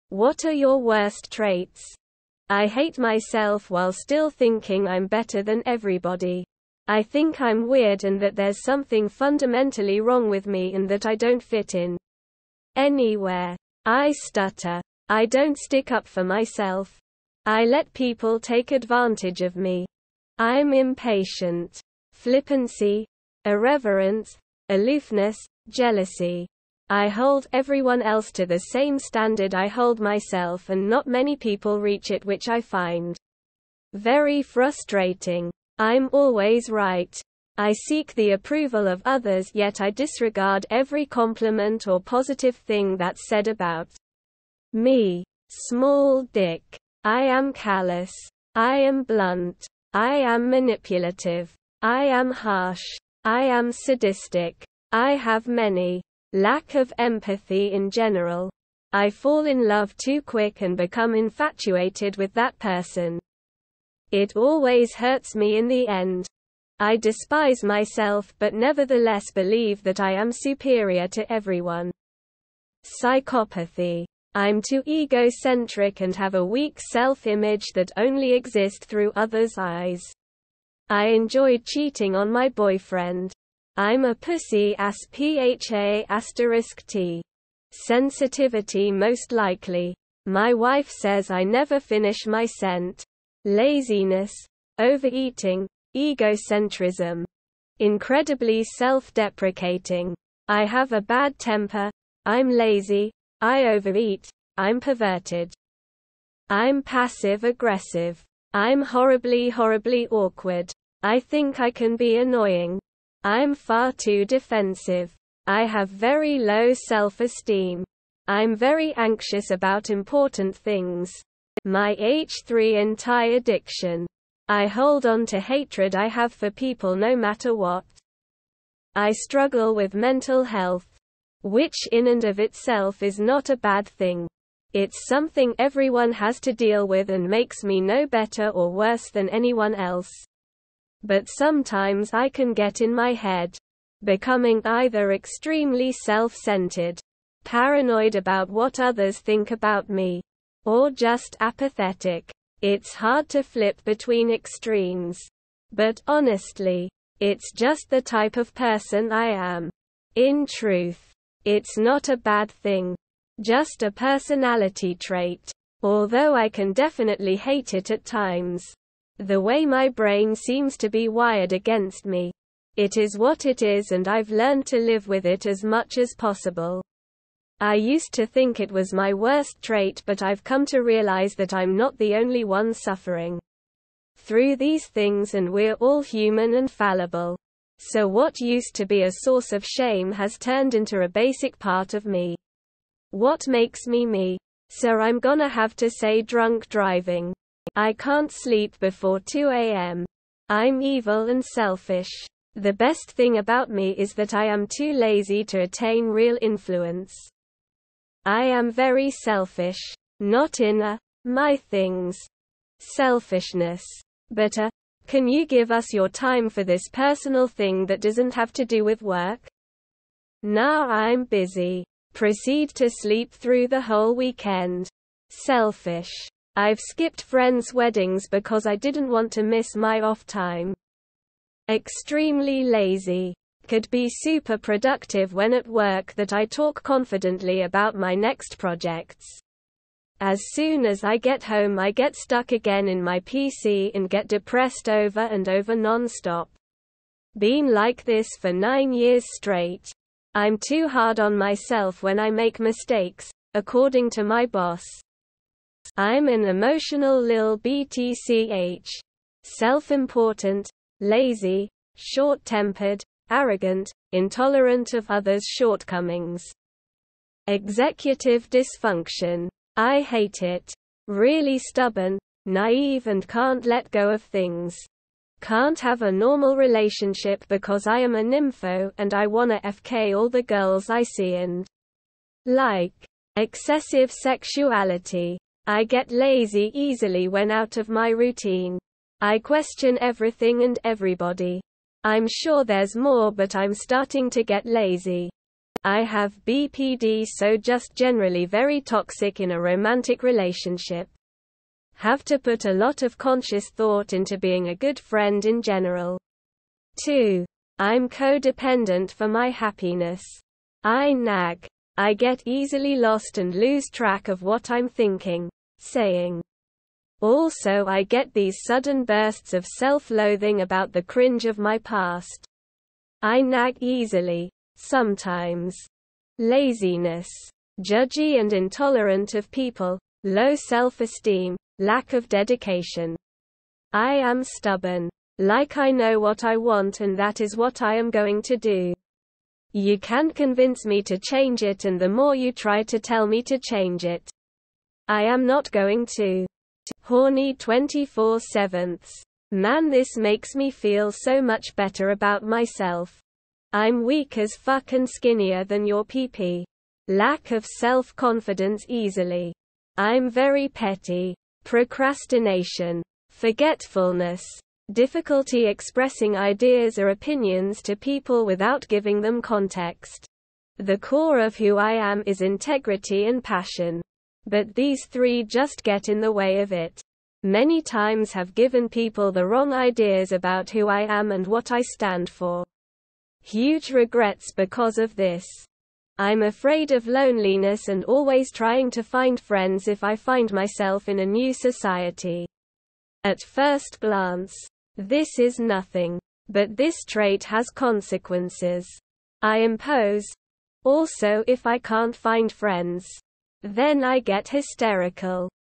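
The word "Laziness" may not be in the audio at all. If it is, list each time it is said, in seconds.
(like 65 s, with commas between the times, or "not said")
93 s, 326 s.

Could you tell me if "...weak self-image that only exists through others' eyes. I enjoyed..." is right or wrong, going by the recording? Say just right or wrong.
right.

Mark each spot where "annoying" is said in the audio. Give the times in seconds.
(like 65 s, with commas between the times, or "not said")
112 s.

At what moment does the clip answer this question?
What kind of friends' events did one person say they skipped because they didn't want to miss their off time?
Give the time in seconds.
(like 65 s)
227 s.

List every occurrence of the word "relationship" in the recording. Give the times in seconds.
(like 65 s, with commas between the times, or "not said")
276 s, 300 s.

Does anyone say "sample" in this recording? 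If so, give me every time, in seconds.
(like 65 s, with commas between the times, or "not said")
not said.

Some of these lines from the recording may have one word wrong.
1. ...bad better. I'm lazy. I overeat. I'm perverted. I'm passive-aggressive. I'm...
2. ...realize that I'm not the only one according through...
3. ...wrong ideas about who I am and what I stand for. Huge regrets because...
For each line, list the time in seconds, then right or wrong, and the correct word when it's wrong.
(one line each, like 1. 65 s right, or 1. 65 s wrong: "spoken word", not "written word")
1. 101 s wrong: "temper", not "better"
2. 180 s wrong: "suffering", not "according"
3. 379 s right.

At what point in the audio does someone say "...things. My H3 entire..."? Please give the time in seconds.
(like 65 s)
120 s.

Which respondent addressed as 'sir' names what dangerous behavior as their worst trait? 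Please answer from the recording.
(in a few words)
Drunk driving.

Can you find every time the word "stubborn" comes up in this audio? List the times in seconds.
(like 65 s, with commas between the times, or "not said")
271 s, 334 s.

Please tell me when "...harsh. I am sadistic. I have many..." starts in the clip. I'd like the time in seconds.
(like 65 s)
52 s.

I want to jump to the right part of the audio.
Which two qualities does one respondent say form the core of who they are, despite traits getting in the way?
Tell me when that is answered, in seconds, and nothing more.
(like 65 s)
372 s.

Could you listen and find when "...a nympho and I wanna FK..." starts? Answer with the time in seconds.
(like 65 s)
278 s.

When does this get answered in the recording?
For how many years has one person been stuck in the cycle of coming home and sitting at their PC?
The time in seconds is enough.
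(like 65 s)
248 s.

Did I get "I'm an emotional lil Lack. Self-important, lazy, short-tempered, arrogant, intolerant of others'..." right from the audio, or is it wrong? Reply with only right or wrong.
wrong.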